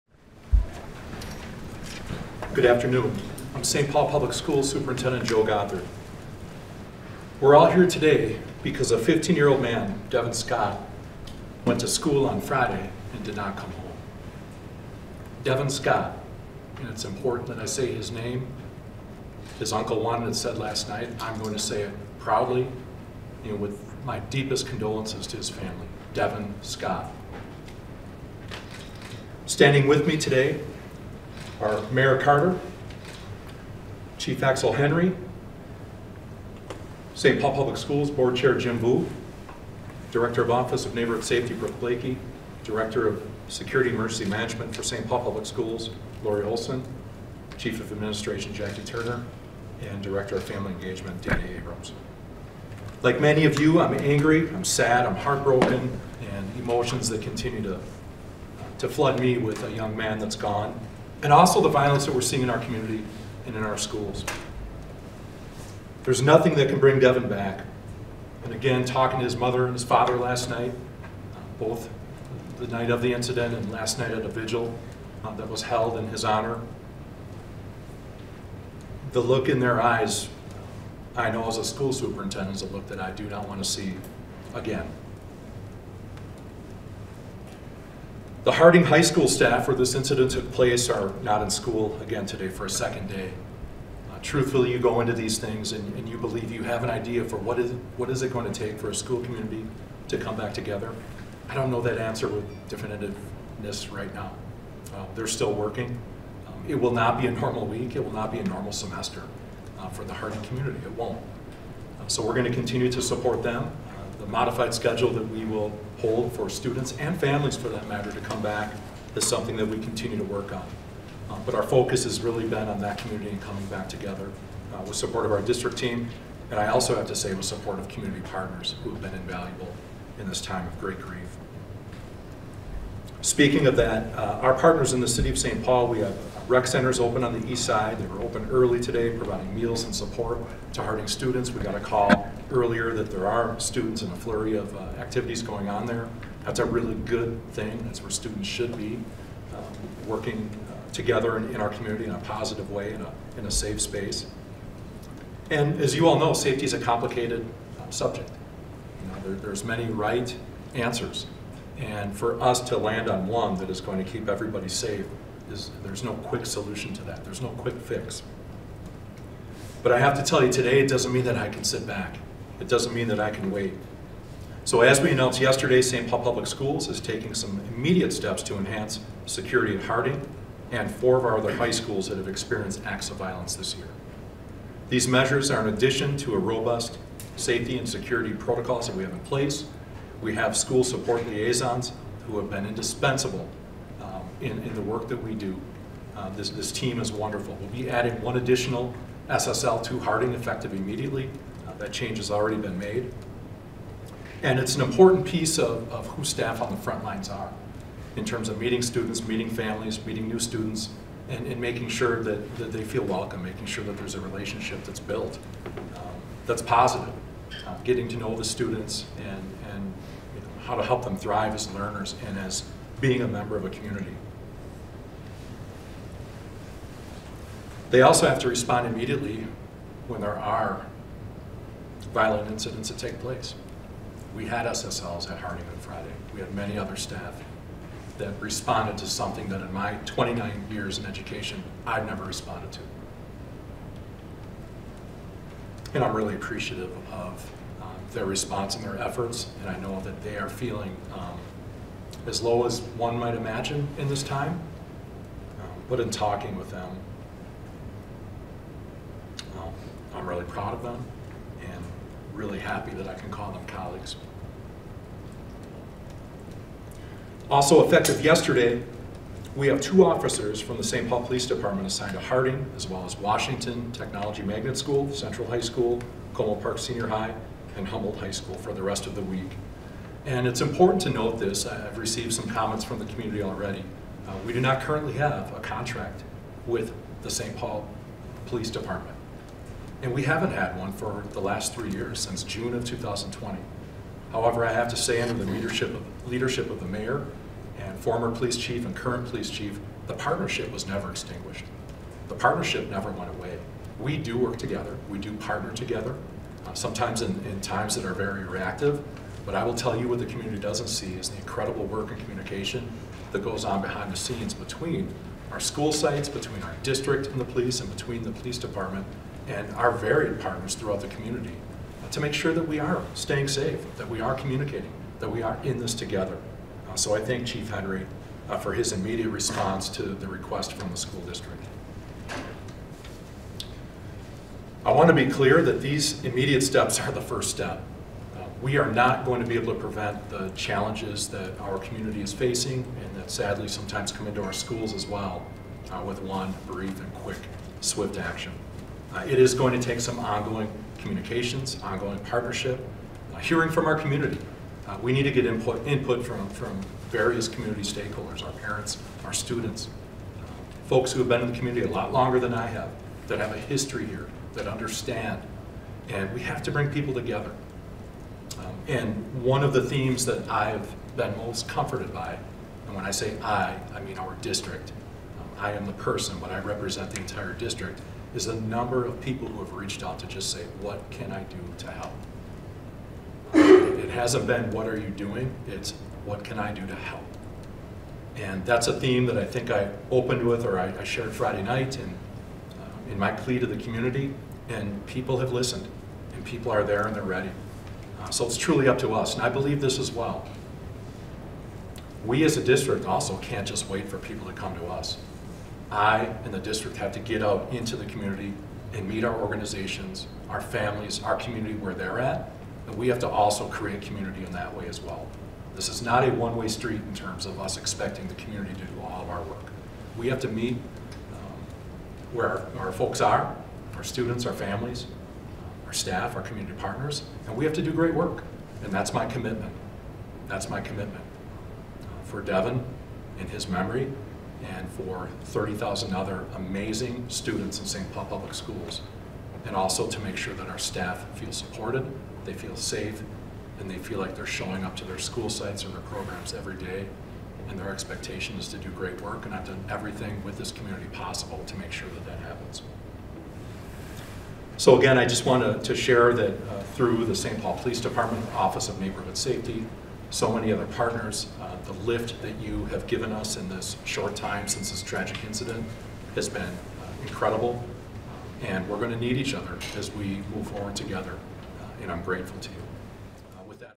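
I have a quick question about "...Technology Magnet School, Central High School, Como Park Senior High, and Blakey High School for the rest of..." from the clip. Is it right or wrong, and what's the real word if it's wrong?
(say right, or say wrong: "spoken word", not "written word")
wrong: "Humboldt", not "Blakey".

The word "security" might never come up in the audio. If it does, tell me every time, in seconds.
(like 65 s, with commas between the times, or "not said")
43 s, 179 s, 187 s.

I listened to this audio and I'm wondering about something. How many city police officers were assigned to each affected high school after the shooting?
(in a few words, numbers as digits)
2.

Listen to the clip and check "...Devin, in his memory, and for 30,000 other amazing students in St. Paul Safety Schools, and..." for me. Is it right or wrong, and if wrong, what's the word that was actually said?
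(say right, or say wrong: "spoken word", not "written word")
wrong: "Public", not "Safety".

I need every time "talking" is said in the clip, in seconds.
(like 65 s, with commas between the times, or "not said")
68 s, 256 s.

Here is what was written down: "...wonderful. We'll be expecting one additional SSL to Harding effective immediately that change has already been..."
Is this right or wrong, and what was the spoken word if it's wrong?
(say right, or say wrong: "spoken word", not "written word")
wrong: "adding", not "expecting".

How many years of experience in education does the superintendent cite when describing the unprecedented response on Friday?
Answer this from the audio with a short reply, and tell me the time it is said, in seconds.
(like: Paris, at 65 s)
29, at 240 s.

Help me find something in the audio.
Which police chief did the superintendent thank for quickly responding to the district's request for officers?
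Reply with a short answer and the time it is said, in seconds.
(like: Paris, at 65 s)
Chief Henry, at 327 s.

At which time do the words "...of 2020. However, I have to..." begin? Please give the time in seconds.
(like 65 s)
292 s.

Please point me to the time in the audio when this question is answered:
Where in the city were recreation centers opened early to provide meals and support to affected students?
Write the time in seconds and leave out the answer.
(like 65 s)
137 s.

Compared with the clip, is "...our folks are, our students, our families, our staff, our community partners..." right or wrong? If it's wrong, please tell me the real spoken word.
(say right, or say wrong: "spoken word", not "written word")
right.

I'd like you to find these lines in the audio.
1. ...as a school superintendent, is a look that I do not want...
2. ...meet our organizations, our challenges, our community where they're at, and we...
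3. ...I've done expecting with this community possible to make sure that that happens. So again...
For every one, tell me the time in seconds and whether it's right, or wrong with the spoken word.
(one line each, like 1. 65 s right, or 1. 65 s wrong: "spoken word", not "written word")
1. 81 s right
2. 409 s wrong: "families", not "challenges"
3. 449 s wrong: "everything", not "expecting".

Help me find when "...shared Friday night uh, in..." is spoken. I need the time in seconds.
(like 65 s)
391 s.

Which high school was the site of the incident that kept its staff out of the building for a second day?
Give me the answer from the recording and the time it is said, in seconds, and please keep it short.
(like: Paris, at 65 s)
Harding High School, at 88 s.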